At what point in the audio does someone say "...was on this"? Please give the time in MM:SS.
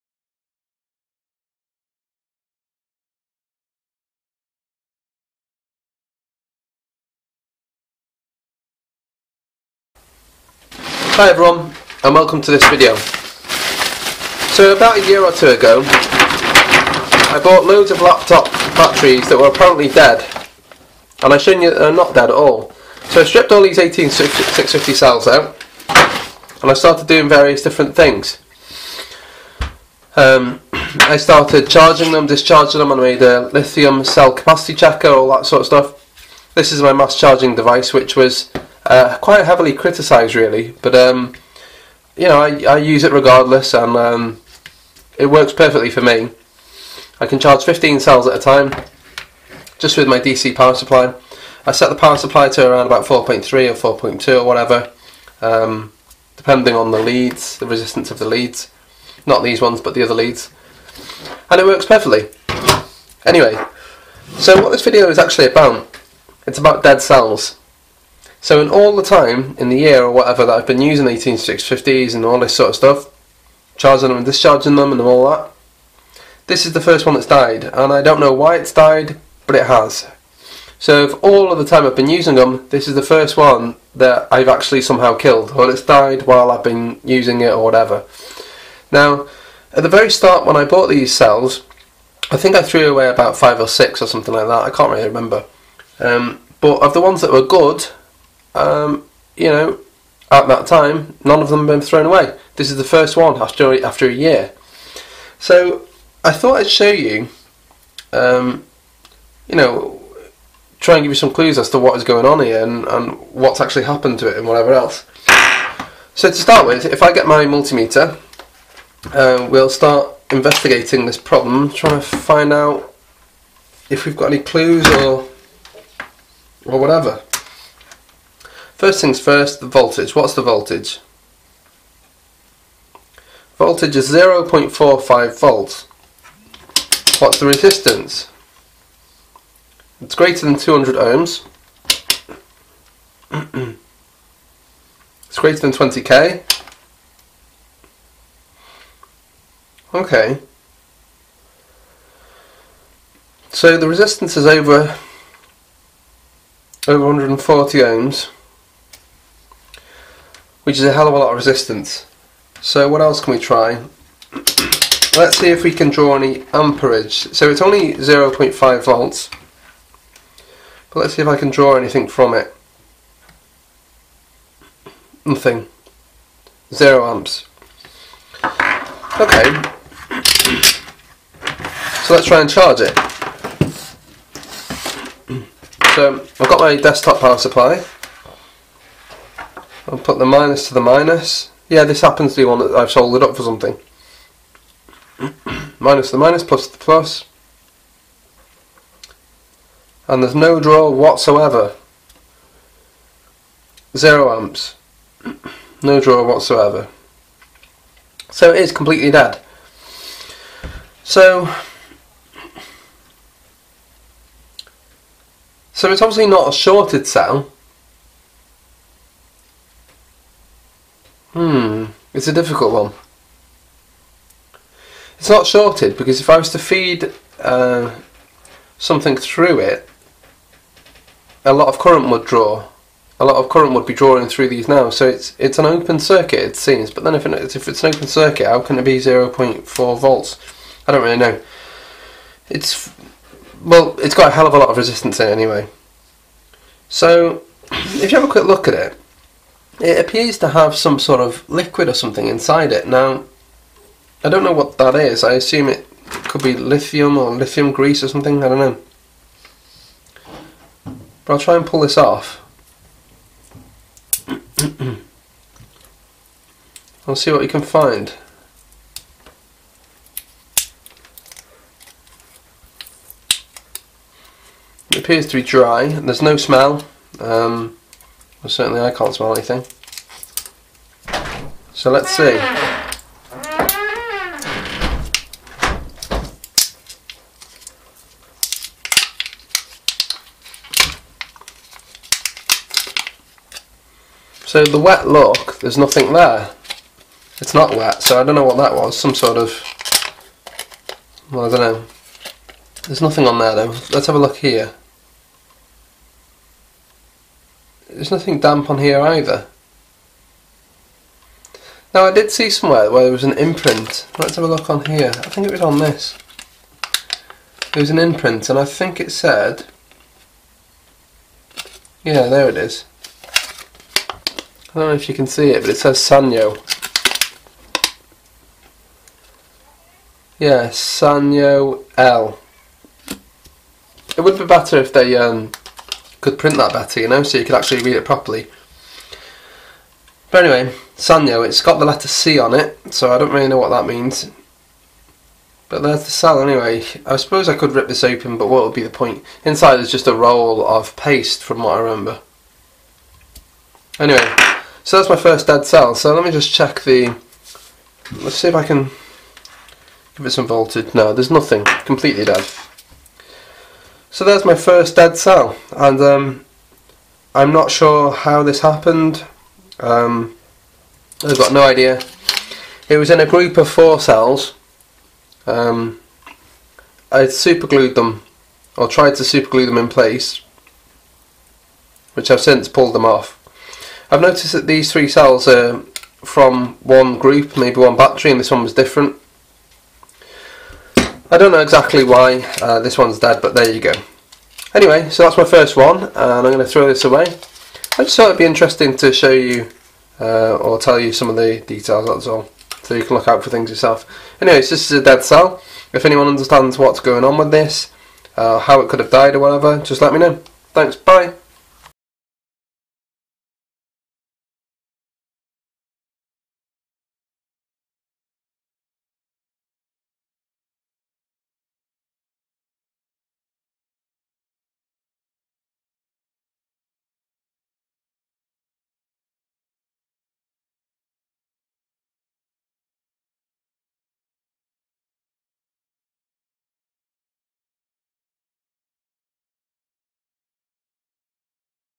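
05:15.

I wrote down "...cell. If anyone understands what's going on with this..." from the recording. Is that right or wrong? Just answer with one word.
right.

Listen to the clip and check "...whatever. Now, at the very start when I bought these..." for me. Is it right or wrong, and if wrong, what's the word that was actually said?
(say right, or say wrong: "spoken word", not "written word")
right.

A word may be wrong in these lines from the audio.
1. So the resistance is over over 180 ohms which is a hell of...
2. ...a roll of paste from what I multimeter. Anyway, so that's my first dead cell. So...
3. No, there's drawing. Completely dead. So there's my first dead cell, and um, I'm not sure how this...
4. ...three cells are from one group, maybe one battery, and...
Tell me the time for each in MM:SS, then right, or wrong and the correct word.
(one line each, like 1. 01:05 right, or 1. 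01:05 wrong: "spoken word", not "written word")
1. 02:33 wrong: "140", not "180"
2. 05:50 wrong: "remember", not "multimeter"
3. 06:00 wrong: "nothing", not "drawing"
4. 06:24 right.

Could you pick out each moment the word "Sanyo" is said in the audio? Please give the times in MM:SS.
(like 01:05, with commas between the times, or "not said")
05:25, 05:30, 05:40.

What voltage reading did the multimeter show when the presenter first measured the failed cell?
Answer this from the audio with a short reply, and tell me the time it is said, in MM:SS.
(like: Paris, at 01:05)
0.45 volts, at 02:14.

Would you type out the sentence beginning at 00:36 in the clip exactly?
This is my mass charging device, which was uh, quite heavily criticised, really.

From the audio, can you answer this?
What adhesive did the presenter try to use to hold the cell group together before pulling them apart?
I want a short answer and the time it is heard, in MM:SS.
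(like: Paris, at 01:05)
Superglue, at 06:17.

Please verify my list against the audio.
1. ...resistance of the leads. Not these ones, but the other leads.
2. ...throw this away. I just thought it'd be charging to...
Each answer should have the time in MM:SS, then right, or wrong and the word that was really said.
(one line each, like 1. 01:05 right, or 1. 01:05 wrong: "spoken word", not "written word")
1. 00:57 right
2. 06:36 wrong: "interesting", not "charging".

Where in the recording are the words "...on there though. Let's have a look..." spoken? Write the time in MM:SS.
05:03.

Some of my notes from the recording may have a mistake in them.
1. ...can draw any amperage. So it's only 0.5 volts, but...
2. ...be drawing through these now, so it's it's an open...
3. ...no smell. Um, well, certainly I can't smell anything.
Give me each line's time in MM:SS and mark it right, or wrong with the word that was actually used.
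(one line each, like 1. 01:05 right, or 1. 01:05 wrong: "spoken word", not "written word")
1. 02:45 right
2. 03:53 right
3. 04:36 right.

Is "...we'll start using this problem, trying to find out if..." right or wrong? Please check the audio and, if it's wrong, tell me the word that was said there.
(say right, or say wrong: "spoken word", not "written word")
wrong: "investigating", not "using".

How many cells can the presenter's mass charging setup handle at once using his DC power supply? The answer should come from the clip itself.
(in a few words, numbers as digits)
15.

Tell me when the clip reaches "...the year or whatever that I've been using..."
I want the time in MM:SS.
01:09.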